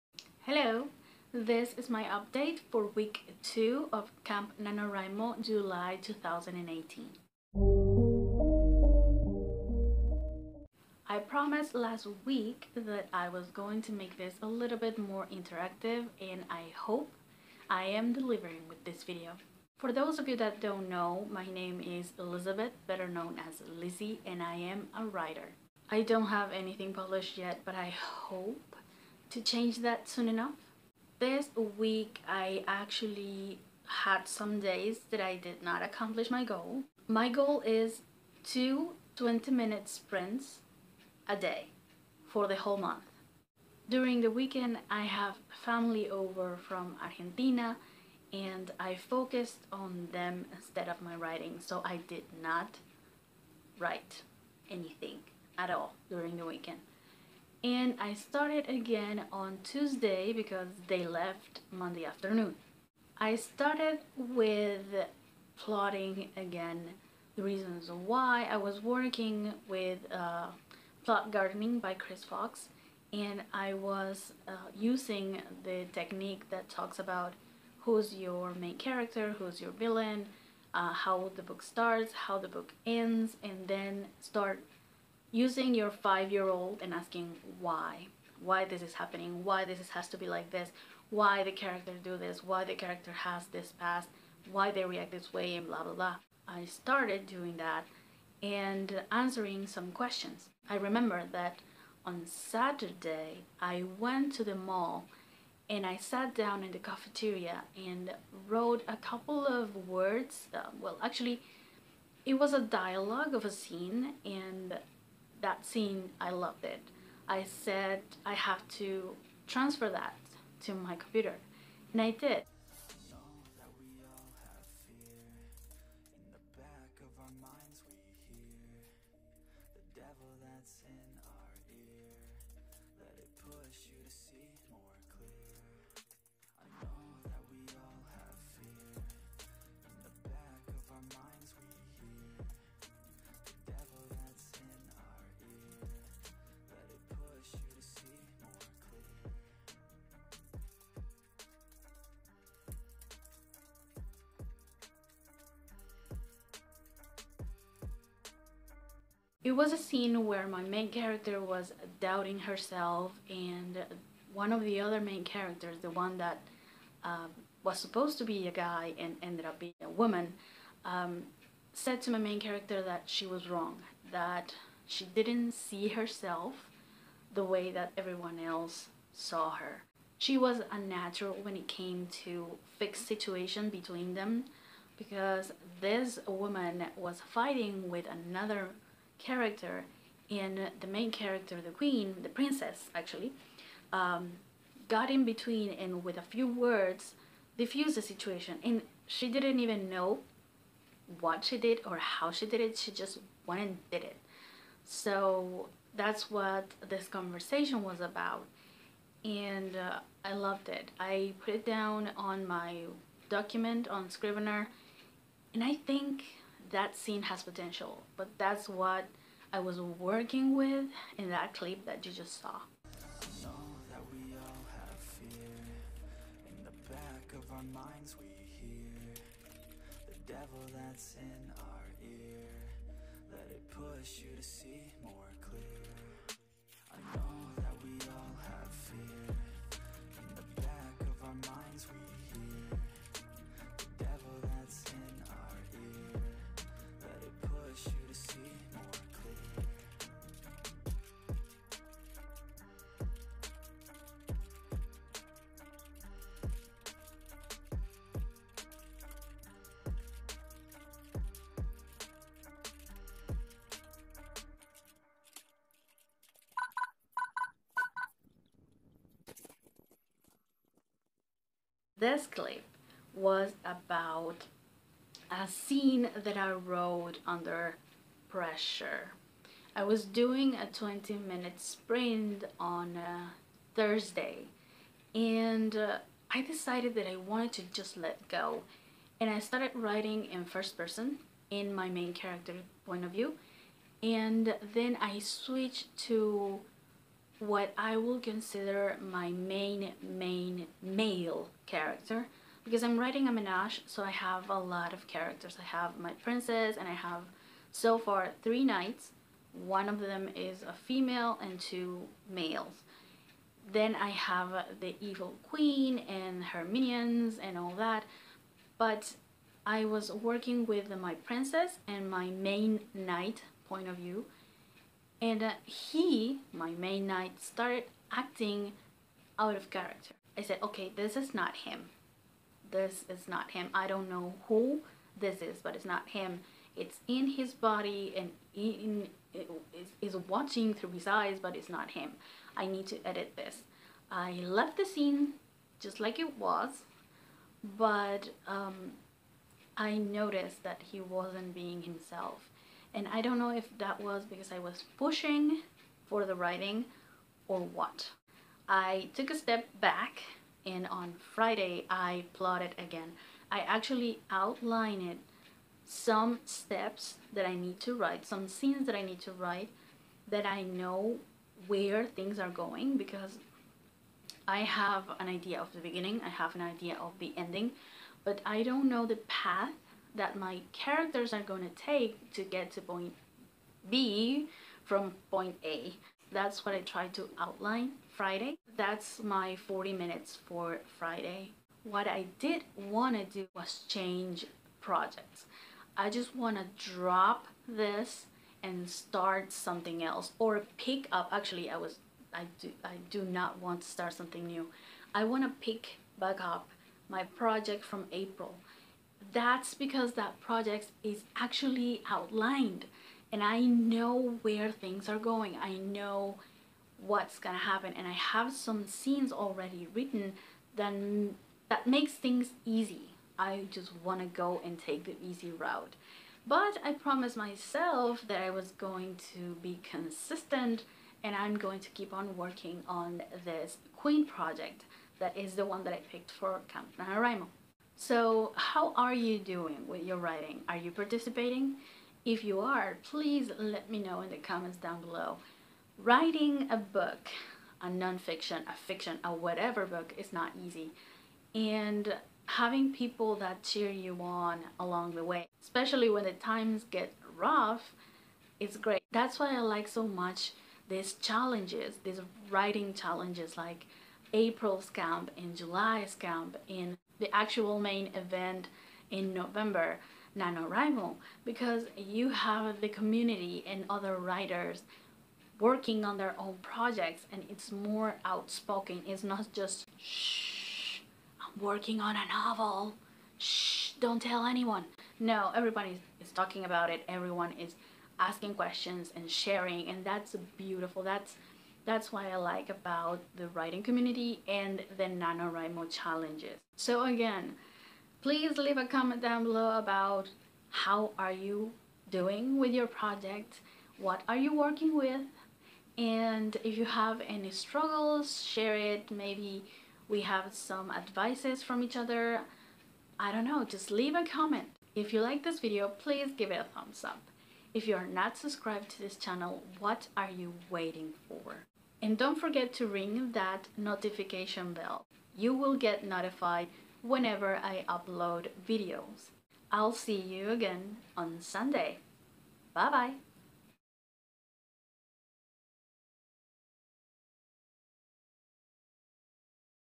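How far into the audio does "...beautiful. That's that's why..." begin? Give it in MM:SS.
08:10.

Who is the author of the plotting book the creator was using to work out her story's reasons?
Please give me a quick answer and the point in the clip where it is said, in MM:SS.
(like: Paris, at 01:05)
Chris Fox, at 01:11.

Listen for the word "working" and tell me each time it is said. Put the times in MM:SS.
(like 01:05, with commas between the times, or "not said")
01:08, 03:39, 05:20, 07:12, 07:55, 08:01, 08:24.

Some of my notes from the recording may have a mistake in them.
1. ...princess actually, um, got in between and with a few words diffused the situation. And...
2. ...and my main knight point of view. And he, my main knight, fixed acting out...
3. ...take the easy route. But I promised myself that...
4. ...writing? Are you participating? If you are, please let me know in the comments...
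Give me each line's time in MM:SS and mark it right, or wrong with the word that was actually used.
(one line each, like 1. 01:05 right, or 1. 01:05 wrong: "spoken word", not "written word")
1. 03:12 right
2. 05:21 wrong: "started", not "fixed"
3. 07:04 right
4. 07:20 right.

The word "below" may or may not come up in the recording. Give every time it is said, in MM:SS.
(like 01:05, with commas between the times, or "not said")
07:25, 08:19.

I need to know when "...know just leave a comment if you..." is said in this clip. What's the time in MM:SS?
08:33.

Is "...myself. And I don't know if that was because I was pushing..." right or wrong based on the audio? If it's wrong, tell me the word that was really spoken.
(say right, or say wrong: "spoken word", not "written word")
wrong: "himself", not "myself".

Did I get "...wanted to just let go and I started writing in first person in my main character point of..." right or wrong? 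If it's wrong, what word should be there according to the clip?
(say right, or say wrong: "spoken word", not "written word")
right.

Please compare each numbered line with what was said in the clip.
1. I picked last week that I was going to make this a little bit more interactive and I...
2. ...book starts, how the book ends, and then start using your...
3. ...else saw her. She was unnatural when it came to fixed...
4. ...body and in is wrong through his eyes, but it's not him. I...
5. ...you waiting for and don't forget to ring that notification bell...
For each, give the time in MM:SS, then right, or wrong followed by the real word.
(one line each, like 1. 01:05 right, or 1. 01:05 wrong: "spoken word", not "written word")
1. 00:11 wrong: "promised", not "picked"
2. 01:21 right
3. 02:58 right
4. 05:37 wrong: "watching", not "wrong"
5. 08:40 right.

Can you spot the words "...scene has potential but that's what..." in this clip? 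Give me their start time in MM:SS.
03:36.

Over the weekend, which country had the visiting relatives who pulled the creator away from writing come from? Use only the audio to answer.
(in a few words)
Argentina.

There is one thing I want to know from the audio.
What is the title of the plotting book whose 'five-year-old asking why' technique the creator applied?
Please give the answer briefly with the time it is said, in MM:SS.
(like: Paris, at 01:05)
Plot Gardening, at 01:11.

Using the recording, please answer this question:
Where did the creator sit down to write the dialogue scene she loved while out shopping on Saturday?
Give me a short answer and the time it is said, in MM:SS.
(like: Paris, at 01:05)
the cafeteria, at 01:46.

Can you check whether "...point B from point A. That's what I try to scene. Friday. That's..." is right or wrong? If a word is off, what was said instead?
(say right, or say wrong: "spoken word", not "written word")
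wrong: "outline", not "scene".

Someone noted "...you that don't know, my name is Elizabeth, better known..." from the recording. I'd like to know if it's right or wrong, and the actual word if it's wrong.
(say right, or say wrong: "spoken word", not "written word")
right.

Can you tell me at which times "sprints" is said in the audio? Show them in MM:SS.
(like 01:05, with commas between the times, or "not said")
00:39, 04:41.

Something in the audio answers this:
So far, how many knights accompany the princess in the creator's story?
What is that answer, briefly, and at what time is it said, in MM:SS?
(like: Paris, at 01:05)
3, at 05:08.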